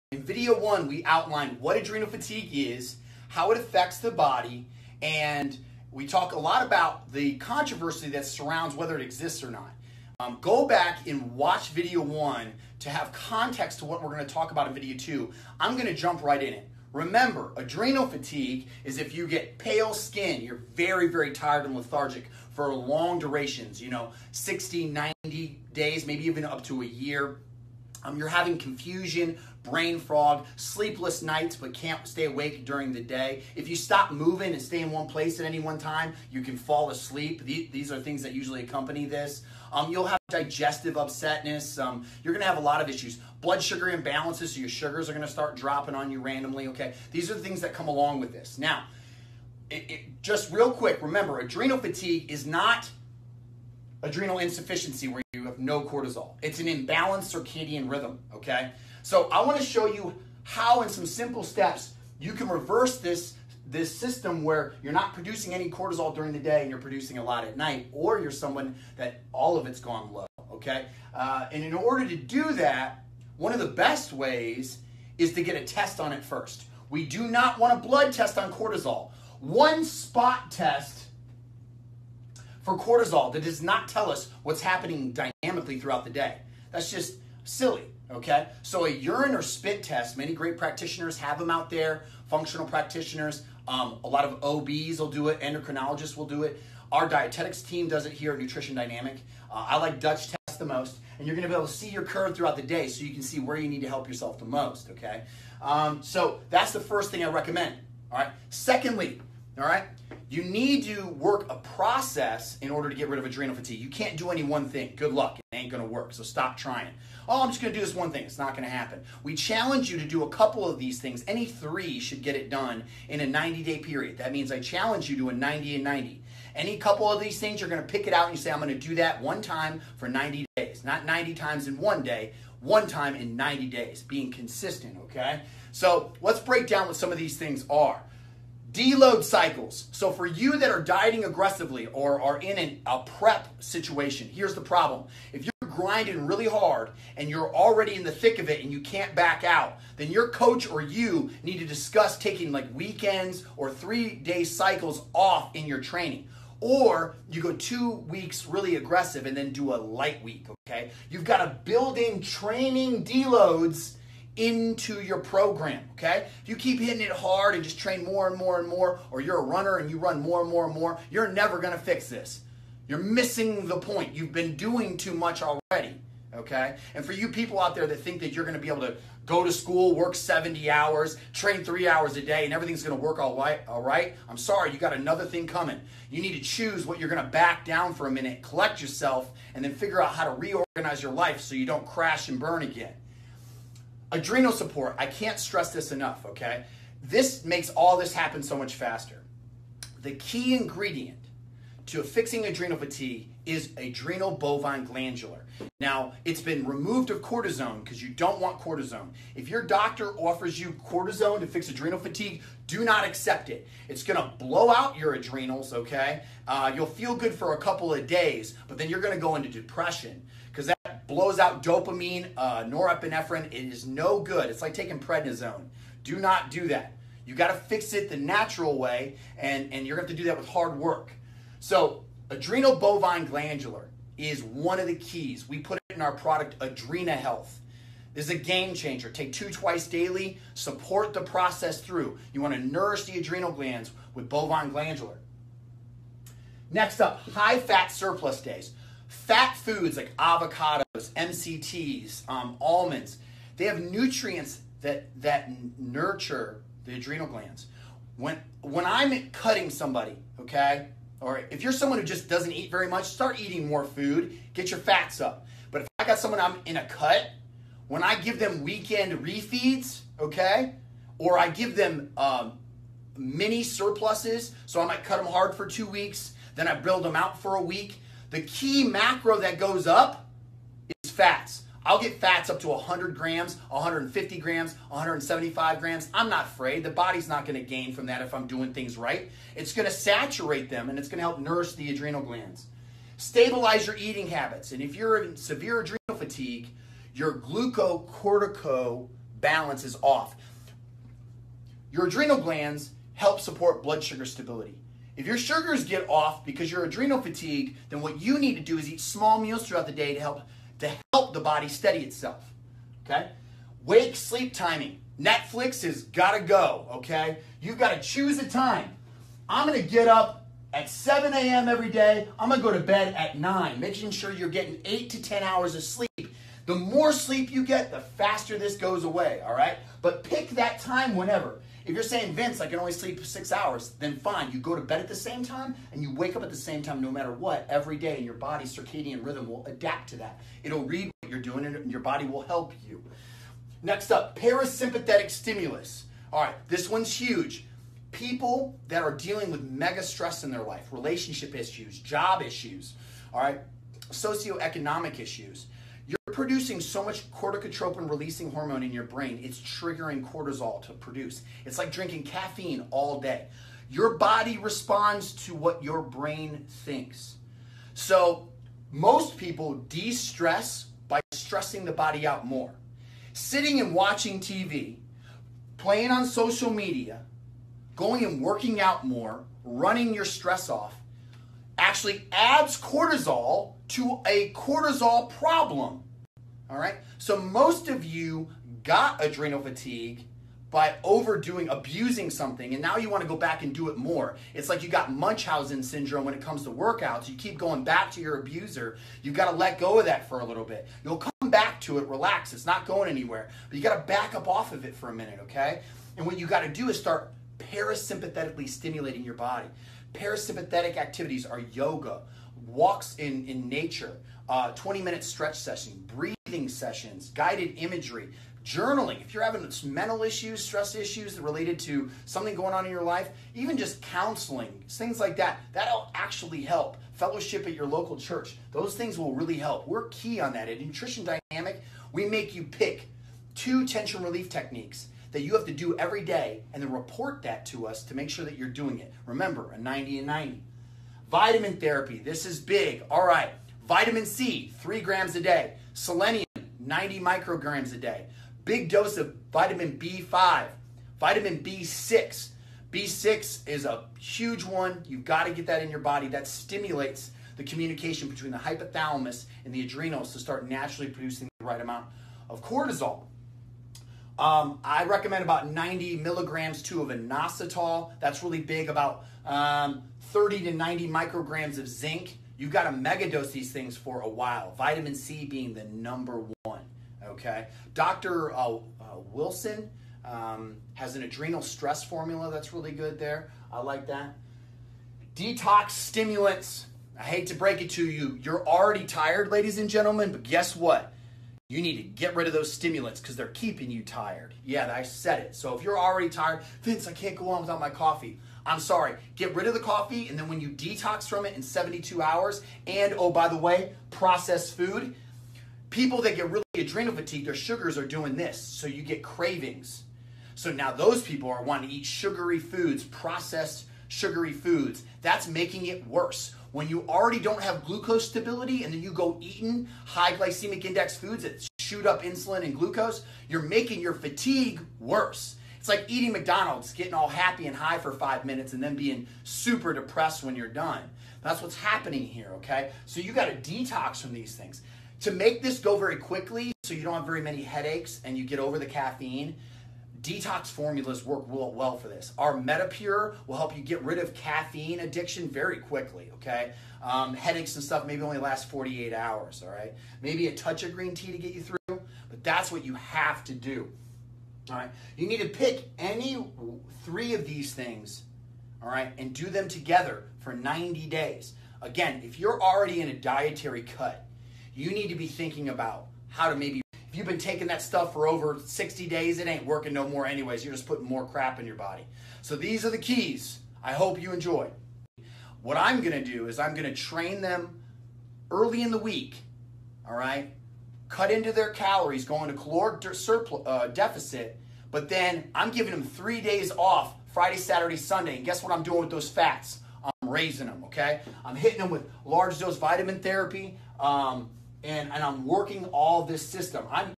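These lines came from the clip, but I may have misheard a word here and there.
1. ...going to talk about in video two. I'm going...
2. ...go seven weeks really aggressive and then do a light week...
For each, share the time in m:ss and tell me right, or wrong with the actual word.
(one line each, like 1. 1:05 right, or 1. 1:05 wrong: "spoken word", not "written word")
1. 0:14 right
2. 2:37 wrong: "two", not "seven".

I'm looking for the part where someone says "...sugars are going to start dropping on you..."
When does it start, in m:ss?
0:44.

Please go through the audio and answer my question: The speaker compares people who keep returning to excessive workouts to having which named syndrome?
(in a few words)
Munchausen syndrome.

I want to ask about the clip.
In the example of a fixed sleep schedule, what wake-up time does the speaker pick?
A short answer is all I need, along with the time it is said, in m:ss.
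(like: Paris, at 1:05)
7 a.m., at 5:20.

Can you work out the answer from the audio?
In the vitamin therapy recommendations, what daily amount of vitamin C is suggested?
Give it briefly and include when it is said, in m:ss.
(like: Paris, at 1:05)
3 grams, at 7:24.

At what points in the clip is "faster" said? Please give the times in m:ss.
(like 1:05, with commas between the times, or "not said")
3:18, 5:27.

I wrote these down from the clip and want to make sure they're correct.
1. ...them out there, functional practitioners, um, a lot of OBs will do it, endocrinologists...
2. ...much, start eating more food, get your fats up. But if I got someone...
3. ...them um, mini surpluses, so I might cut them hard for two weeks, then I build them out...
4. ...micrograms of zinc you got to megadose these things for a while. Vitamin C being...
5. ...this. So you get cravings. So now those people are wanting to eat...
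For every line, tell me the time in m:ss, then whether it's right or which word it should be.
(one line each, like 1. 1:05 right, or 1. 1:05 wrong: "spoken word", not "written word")
1. 1:31 right
2. 4:22 right
3. 4:31 right
4. 7:51 right
5. 8:28 right.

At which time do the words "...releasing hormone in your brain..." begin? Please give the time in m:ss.
5:58.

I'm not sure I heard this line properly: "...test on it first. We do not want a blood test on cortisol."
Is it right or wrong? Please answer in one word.
right.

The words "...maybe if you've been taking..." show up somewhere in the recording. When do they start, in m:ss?
9:26.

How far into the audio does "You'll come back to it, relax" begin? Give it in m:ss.
6:41.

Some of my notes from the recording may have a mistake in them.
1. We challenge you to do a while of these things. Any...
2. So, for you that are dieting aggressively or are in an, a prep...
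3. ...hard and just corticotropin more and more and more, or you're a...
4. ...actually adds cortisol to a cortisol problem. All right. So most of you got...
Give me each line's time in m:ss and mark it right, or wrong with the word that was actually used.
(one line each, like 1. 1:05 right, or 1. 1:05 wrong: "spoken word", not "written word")
1. 1:59 wrong: "couple", not "while"
2. 2:19 right
3. 2:47 wrong: "train", not "corticotropin"
4. 6:21 right.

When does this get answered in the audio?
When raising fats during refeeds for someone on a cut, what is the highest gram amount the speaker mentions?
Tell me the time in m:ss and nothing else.
4:44.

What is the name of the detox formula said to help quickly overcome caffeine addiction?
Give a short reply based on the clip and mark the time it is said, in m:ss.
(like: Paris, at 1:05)
MetaPure, at 9:02.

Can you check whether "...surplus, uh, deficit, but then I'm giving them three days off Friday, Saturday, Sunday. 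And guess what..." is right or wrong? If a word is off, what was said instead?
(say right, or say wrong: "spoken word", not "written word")
right.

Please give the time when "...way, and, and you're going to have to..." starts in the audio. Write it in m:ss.
3:48.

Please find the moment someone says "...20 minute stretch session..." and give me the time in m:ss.
6:54.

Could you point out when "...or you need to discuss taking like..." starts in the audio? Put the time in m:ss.
2:30.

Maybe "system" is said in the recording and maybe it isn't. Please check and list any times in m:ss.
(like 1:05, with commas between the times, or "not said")
1:03, 9:56.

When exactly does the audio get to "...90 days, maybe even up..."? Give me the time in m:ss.
0:25.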